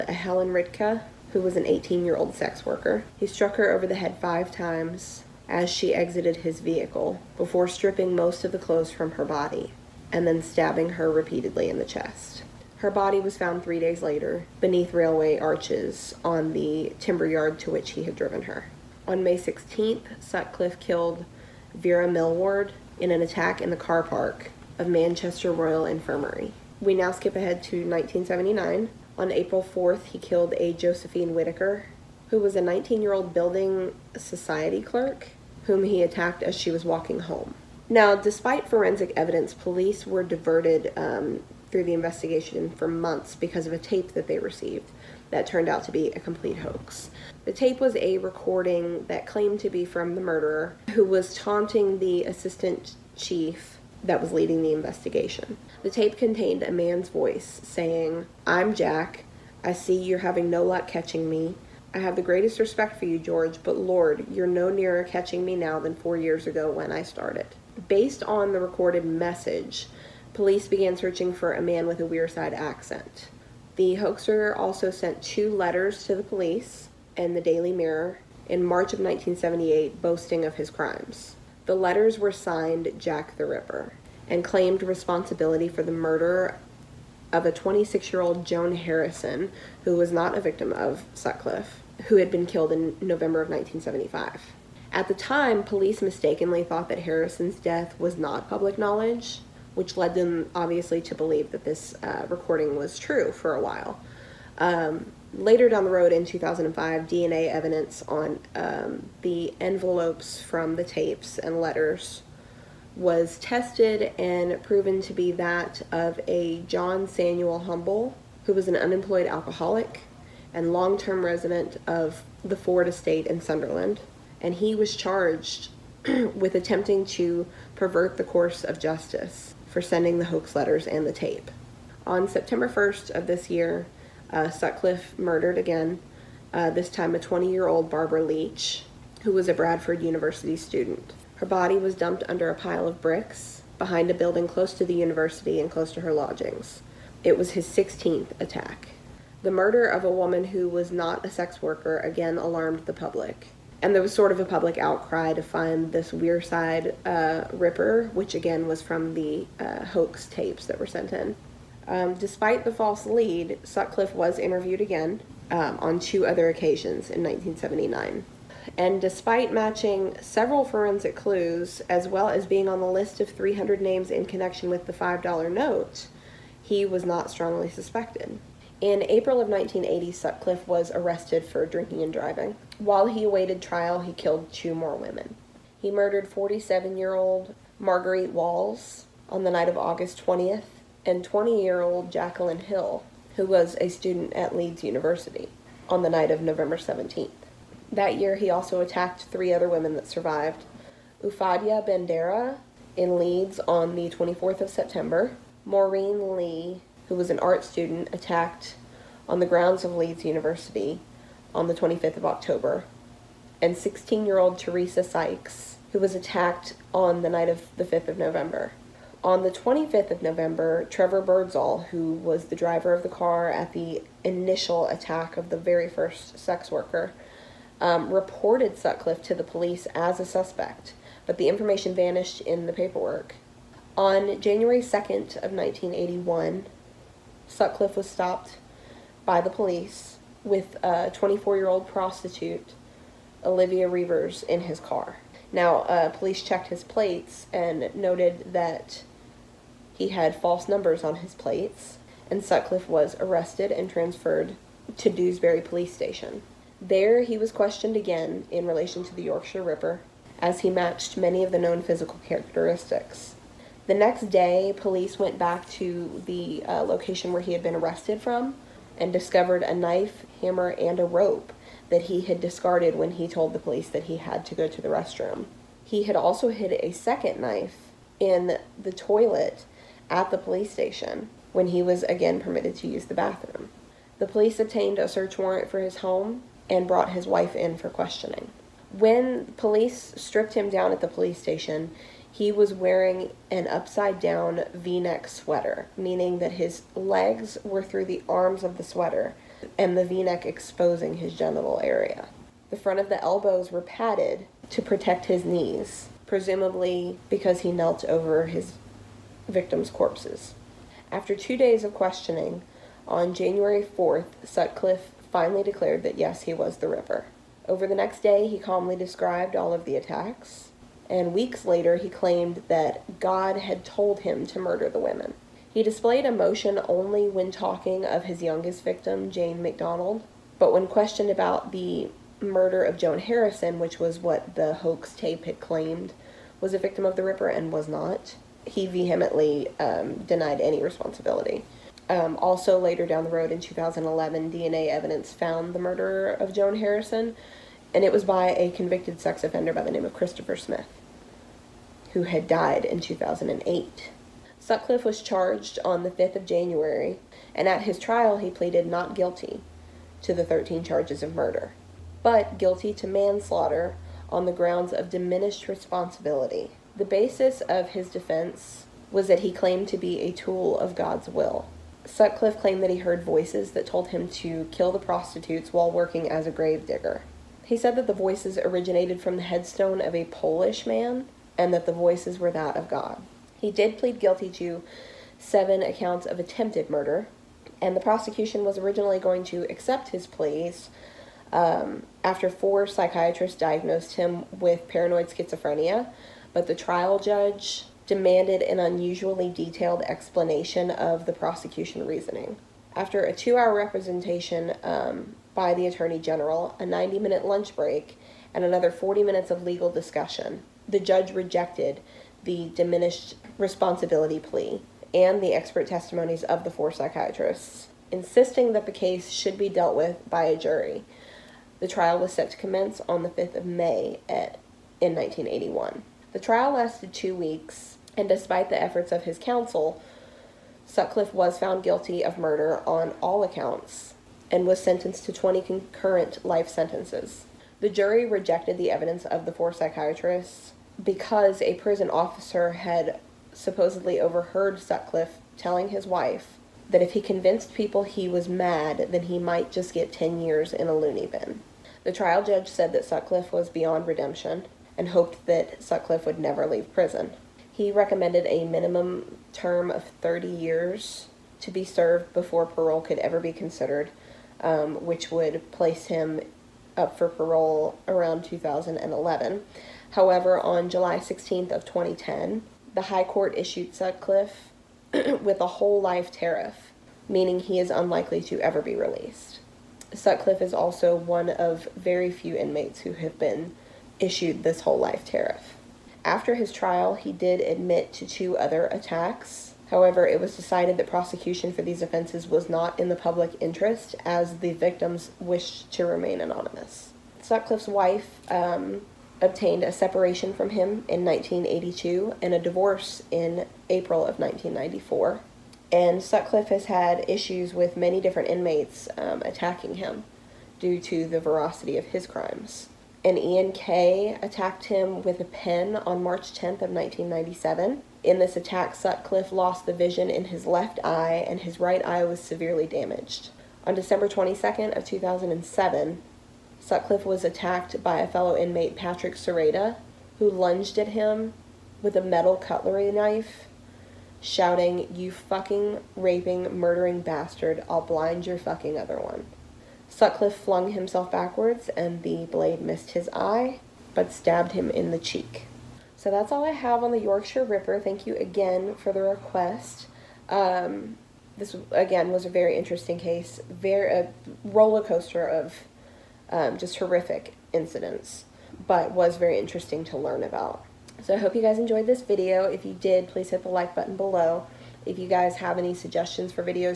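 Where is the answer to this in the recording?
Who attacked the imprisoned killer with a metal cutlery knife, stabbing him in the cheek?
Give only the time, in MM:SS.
08:48.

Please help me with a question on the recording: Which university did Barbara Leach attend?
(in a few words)
Bradford University.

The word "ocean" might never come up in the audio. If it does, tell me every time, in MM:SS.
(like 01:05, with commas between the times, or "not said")
not said.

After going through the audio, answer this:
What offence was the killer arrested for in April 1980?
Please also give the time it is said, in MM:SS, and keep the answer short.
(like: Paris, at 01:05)
Drinking and driving, at 03:01.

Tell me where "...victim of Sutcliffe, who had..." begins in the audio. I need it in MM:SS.
01:30.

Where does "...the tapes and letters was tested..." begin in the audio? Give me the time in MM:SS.
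01:50.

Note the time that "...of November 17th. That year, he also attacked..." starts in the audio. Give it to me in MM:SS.
03:16.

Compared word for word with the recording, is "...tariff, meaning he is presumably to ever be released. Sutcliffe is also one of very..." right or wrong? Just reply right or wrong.
wrong.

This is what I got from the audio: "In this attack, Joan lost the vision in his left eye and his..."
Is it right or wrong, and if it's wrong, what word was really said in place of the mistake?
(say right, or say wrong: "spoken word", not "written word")
wrong: "Sutcliffe", not "Joan".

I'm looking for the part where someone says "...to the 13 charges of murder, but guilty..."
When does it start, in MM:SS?
06:00.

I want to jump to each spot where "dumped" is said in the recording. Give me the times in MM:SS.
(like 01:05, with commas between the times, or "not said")
02:21.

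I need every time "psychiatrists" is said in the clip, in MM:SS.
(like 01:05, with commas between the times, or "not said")
06:32, 06:56, 07:19.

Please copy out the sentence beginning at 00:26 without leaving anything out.
We now skip ahead to 1979.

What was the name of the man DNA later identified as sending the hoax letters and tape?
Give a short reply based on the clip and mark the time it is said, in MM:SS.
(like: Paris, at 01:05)
John Samuel Humble, at 01:56.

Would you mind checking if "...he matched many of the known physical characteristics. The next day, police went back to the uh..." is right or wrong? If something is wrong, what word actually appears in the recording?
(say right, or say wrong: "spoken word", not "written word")
right.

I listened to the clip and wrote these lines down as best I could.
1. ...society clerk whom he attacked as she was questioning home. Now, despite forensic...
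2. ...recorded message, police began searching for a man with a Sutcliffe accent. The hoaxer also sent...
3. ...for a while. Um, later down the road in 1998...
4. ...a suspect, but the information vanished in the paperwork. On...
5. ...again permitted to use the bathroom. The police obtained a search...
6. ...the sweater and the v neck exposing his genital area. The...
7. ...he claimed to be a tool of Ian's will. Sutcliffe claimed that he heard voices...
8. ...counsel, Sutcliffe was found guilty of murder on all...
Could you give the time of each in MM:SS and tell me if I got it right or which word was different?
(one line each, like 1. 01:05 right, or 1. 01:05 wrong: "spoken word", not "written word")
1. 00:34 wrong: "walking", not "questioning"
2. 01:08 wrong: "Wearside", not "Sutcliffe"
3. 01:43 wrong: "2005", not "1998"
4. 03:50 right
5. 04:42 right
6. 04:58 right
7. 06:09 wrong: "God", not "Ian"
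8. 07:09 right.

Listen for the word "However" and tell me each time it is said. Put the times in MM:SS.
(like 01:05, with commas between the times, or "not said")
07:50, 08:09.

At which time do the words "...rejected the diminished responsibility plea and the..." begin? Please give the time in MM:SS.
06:51.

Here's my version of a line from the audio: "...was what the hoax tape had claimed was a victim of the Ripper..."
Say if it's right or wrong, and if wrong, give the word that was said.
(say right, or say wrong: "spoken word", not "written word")
right.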